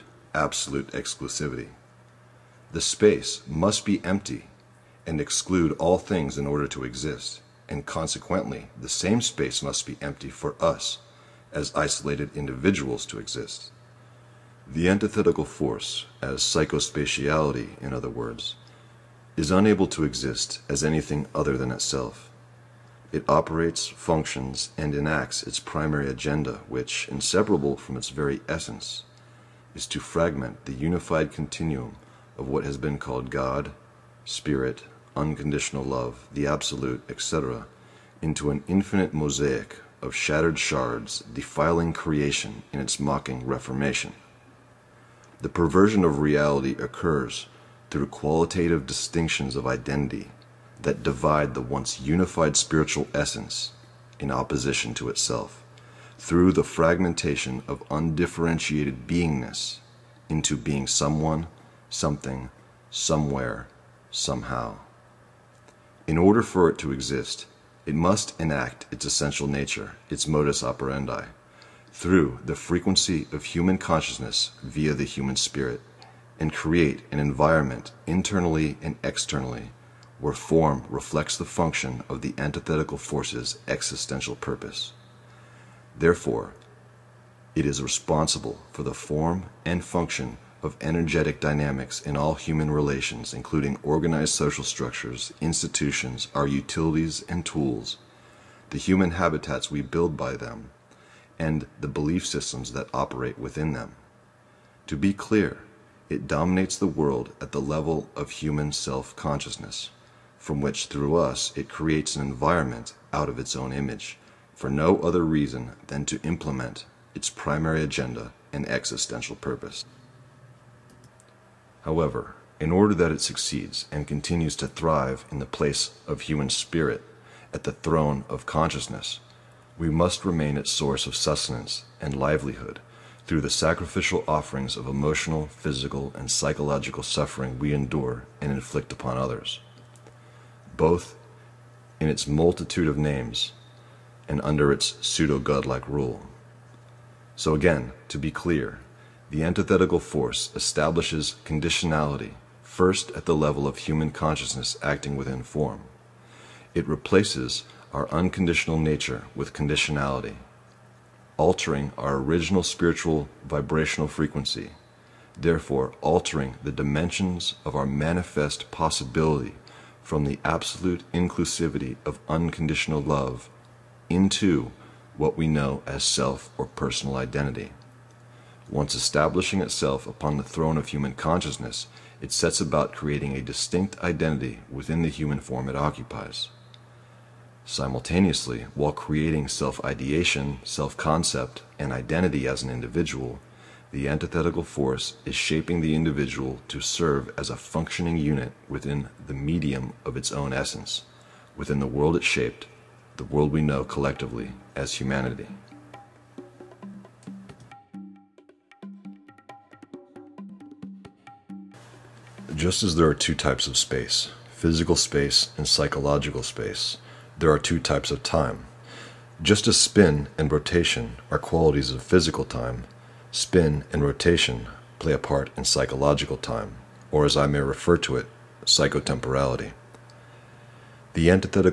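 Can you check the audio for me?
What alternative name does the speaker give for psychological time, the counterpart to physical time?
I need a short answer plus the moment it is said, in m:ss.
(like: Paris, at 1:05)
psychotemporality, at 3:48.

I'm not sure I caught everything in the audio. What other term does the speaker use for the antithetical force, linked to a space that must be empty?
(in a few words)
psychospatiality.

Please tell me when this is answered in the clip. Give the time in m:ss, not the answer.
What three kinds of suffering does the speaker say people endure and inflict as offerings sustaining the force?
2:14.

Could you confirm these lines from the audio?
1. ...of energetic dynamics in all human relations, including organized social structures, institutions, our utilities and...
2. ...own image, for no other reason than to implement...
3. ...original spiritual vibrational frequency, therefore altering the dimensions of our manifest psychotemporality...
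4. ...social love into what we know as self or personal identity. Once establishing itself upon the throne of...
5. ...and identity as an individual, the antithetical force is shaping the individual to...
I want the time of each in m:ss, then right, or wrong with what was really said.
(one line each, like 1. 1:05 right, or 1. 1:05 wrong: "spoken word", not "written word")
1. 1:30 right
2. 1:53 right
3. 2:42 wrong: "possibility", not "psychotemporality"
4. 2:52 wrong: "unconditional", not "social"
5. 3:11 right.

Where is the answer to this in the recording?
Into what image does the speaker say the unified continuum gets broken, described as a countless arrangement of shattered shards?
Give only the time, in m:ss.
0:38.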